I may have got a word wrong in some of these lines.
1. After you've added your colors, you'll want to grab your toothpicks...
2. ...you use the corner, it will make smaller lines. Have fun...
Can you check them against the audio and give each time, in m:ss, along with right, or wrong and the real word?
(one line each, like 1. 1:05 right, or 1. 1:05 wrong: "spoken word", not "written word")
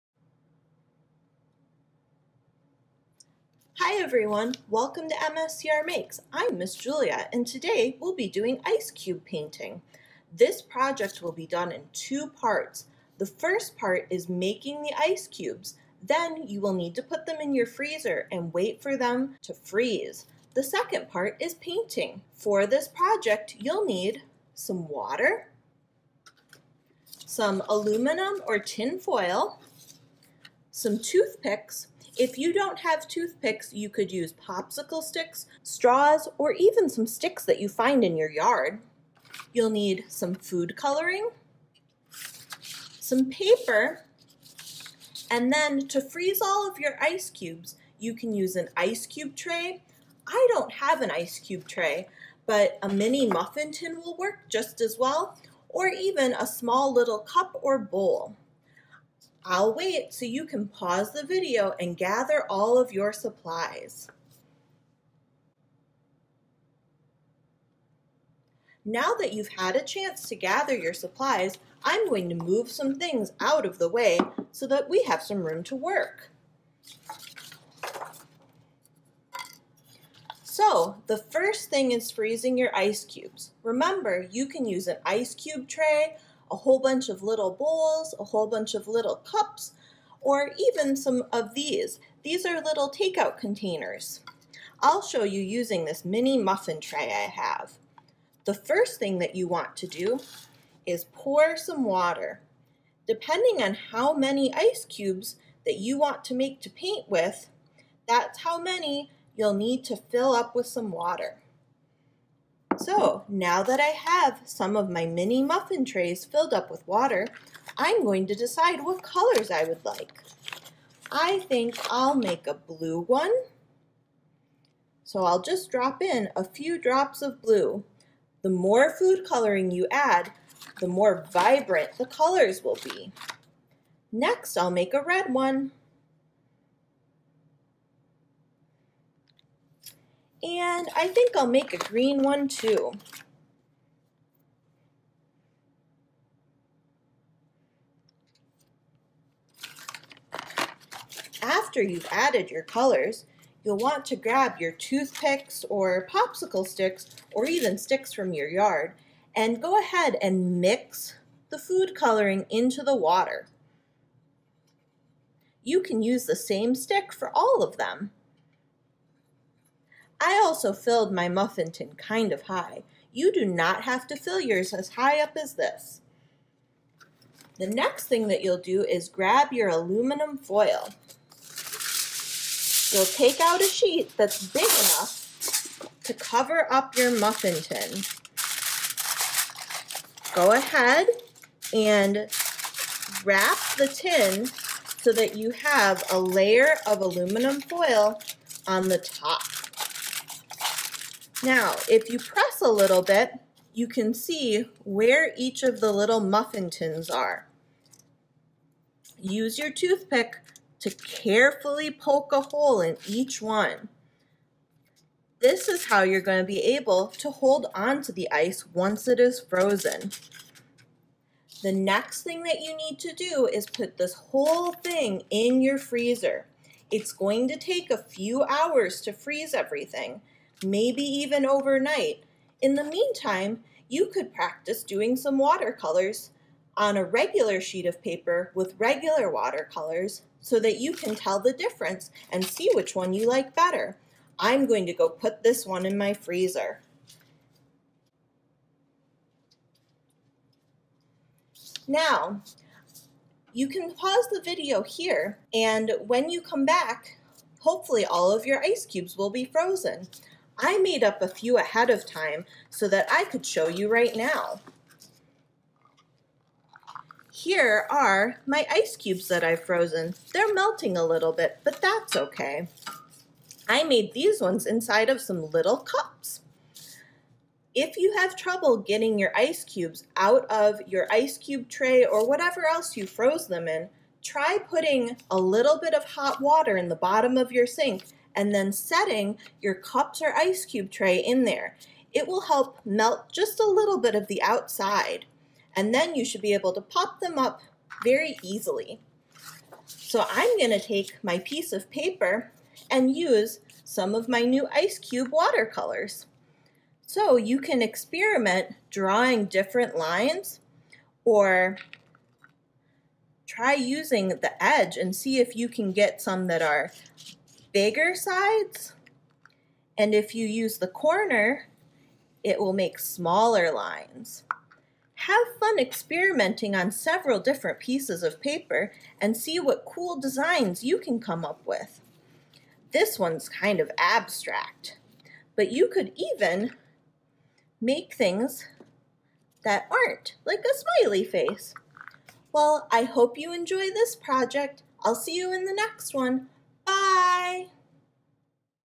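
1. 2:31 right
2. 5:20 right.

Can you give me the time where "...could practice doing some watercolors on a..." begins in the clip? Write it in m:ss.
3:54.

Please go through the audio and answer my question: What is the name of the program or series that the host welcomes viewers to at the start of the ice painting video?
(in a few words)
MSCR Makes.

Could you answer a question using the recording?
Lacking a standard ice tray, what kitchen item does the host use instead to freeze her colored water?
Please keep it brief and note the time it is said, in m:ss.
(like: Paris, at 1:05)
mini muffin tin, at 0:52.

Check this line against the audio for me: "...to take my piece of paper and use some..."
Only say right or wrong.
right.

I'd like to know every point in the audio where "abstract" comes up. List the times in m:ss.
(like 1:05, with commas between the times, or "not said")
5:33.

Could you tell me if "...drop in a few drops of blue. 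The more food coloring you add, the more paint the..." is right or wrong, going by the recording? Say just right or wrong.
wrong.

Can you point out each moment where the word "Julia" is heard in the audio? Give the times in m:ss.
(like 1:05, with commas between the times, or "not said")
0:06.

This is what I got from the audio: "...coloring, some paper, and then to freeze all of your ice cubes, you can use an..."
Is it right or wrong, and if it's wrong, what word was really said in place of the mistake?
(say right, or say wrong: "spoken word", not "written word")
right.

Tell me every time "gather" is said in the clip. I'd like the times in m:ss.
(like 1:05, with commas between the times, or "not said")
1:01, 1:10.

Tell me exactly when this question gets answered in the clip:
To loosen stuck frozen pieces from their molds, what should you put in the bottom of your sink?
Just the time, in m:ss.
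4:46.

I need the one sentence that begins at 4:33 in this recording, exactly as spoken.
I made these ones inside of some little cups.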